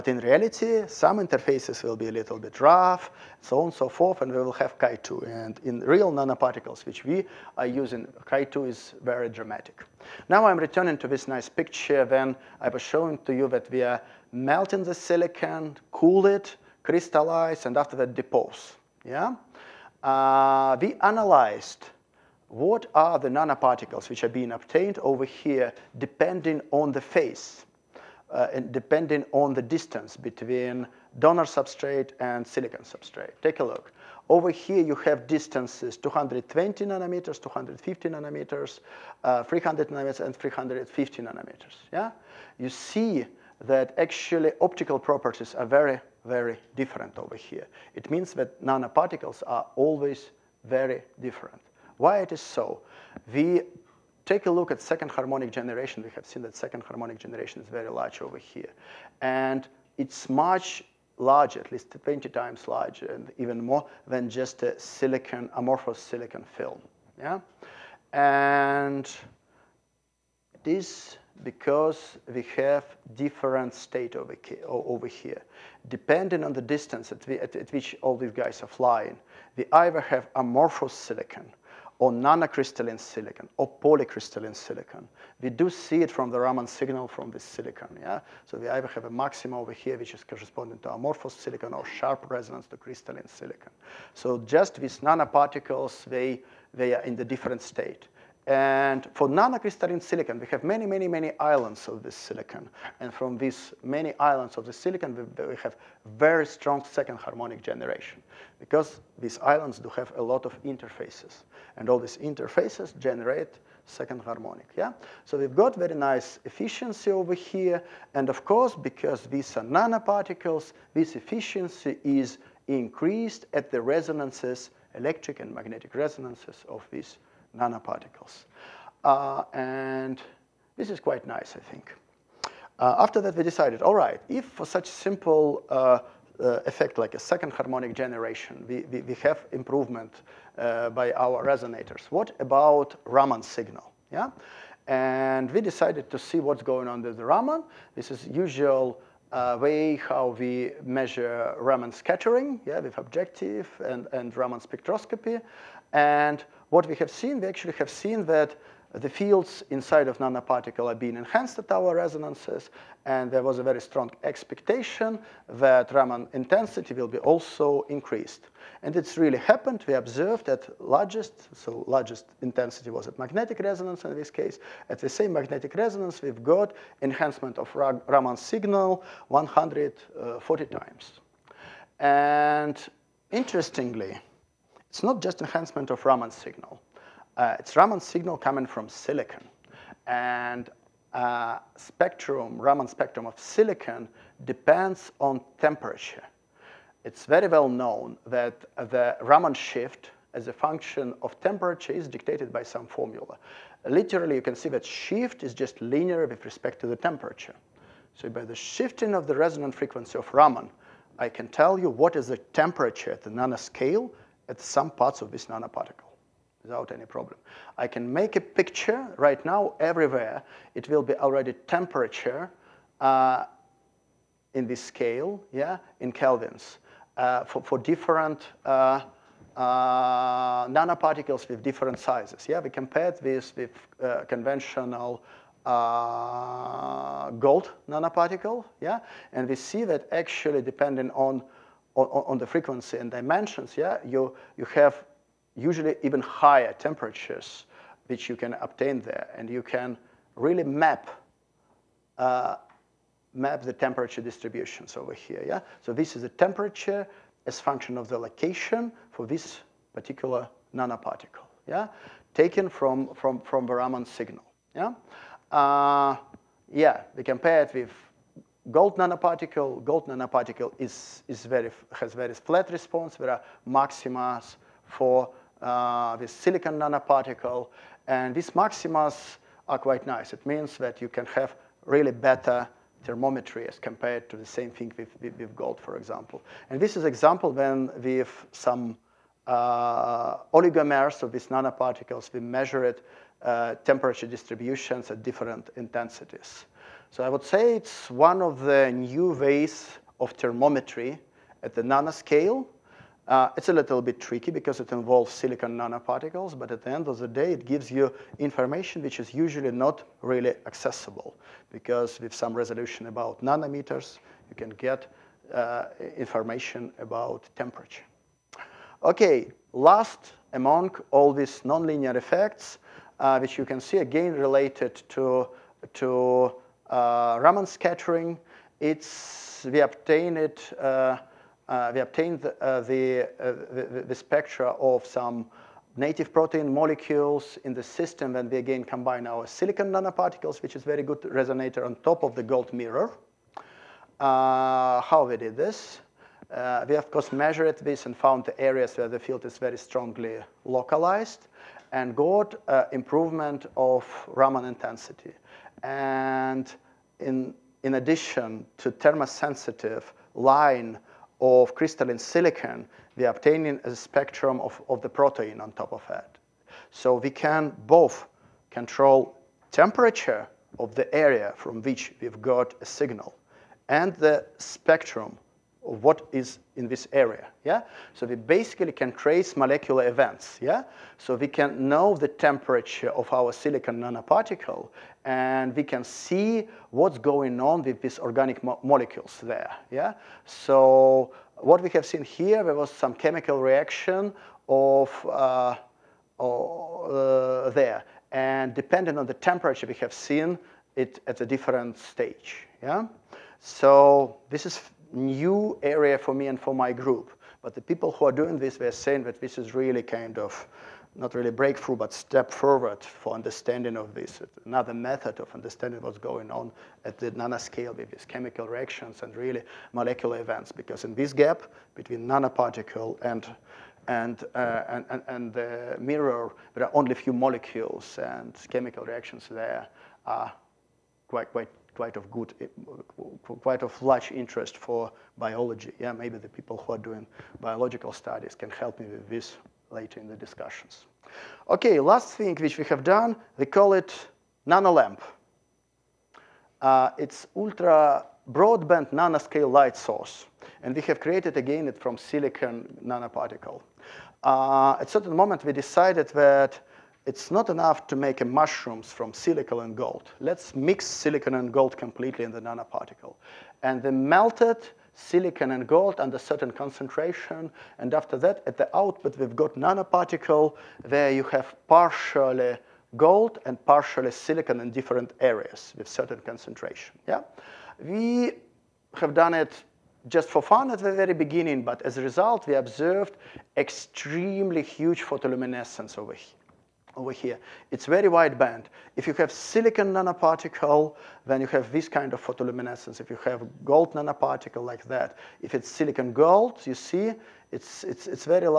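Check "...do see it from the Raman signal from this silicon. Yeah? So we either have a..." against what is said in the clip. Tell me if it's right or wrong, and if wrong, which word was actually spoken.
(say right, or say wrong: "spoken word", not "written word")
right.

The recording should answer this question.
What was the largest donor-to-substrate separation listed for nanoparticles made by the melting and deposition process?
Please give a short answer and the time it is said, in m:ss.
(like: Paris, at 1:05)
350 nanometers, at 0:40.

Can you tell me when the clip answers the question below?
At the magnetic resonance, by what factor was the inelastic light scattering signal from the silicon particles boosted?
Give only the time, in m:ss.
2:59.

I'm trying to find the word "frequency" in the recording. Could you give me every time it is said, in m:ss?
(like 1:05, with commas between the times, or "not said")
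3:29, 4:02.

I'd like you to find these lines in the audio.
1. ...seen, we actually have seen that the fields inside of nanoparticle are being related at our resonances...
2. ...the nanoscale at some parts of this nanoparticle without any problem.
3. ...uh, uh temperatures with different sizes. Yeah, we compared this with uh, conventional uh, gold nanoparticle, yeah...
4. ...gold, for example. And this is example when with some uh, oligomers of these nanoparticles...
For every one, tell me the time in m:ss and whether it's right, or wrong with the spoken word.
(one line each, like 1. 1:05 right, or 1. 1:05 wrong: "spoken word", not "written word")
1. 2:37 wrong: "enhanced", not "related"
2. 3:33 right
3. 3:48 wrong: "nanoparticles", not "temperatures"
4. 4:45 right.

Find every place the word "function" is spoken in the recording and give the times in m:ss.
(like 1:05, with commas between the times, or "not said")
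3:20, 4:17.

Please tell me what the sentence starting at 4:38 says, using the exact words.
And these maxima are quite nice.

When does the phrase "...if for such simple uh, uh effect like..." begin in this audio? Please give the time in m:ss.
2:14.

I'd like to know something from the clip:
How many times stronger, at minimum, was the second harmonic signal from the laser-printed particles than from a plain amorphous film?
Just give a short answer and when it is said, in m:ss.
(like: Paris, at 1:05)
20 times, at 1:01.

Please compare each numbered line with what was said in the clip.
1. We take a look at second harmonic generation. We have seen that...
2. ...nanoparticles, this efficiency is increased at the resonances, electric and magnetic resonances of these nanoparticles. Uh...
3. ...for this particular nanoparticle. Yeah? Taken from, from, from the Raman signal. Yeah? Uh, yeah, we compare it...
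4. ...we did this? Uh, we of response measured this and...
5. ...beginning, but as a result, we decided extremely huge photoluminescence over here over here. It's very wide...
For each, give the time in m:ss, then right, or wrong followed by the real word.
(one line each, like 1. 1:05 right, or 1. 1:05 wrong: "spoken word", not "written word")
1. 0:53 right
2. 1:59 right
3. 4:19 right
4. 5:45 wrong: "course", not "response"
5. 8:01 wrong: "observed", not "decided".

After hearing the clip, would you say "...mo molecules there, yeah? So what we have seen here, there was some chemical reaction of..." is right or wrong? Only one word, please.
right.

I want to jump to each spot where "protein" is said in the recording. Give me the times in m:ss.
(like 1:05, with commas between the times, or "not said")
5:36, 6:05.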